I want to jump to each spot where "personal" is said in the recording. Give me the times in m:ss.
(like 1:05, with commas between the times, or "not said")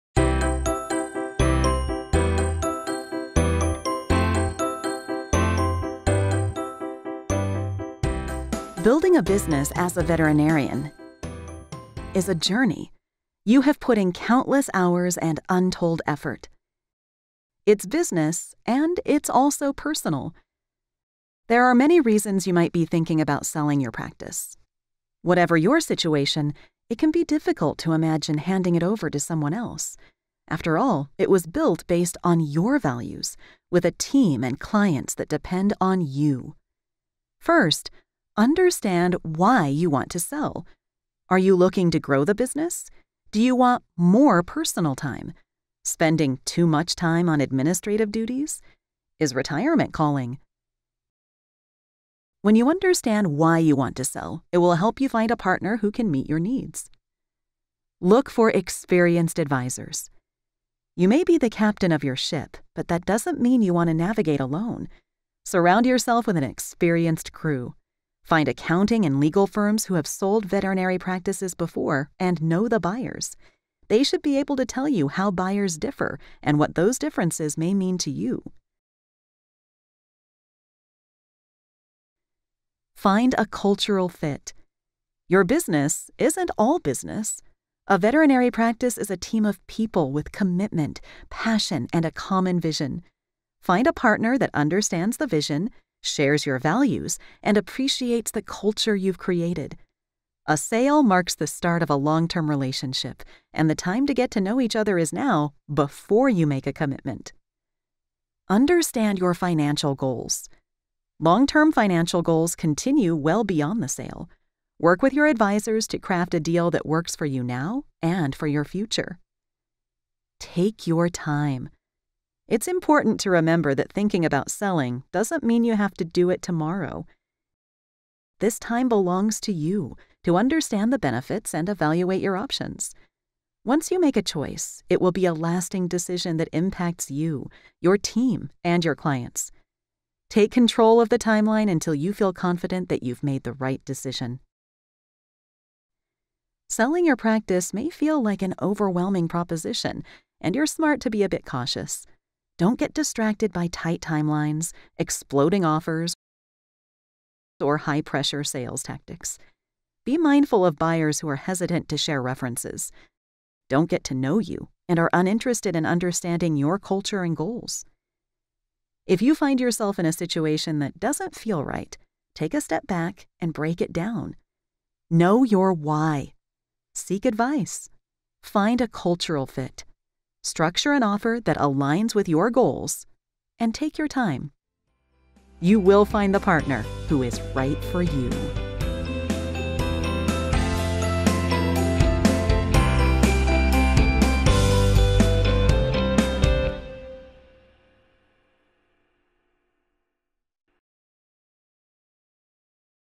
0:19, 0:44.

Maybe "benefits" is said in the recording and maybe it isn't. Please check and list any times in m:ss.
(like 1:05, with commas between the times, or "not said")
2:10.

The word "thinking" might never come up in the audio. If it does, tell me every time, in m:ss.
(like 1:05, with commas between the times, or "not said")
0:22, 2:03.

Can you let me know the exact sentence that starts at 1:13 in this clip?
They should be able to tell you how buyers differ and what those differences may mean to you.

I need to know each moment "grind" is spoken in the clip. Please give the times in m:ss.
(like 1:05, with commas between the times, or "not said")
not said.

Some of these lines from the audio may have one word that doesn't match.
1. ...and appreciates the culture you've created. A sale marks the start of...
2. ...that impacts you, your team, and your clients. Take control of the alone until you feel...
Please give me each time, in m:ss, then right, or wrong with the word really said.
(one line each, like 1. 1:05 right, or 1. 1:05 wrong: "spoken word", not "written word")
1. 1:37 right
2. 2:16 wrong: "timeline", not "alone".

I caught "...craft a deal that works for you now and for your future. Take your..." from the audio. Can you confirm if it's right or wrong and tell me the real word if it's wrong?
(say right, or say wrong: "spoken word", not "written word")
right.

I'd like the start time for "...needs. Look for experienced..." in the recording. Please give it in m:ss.
0:56.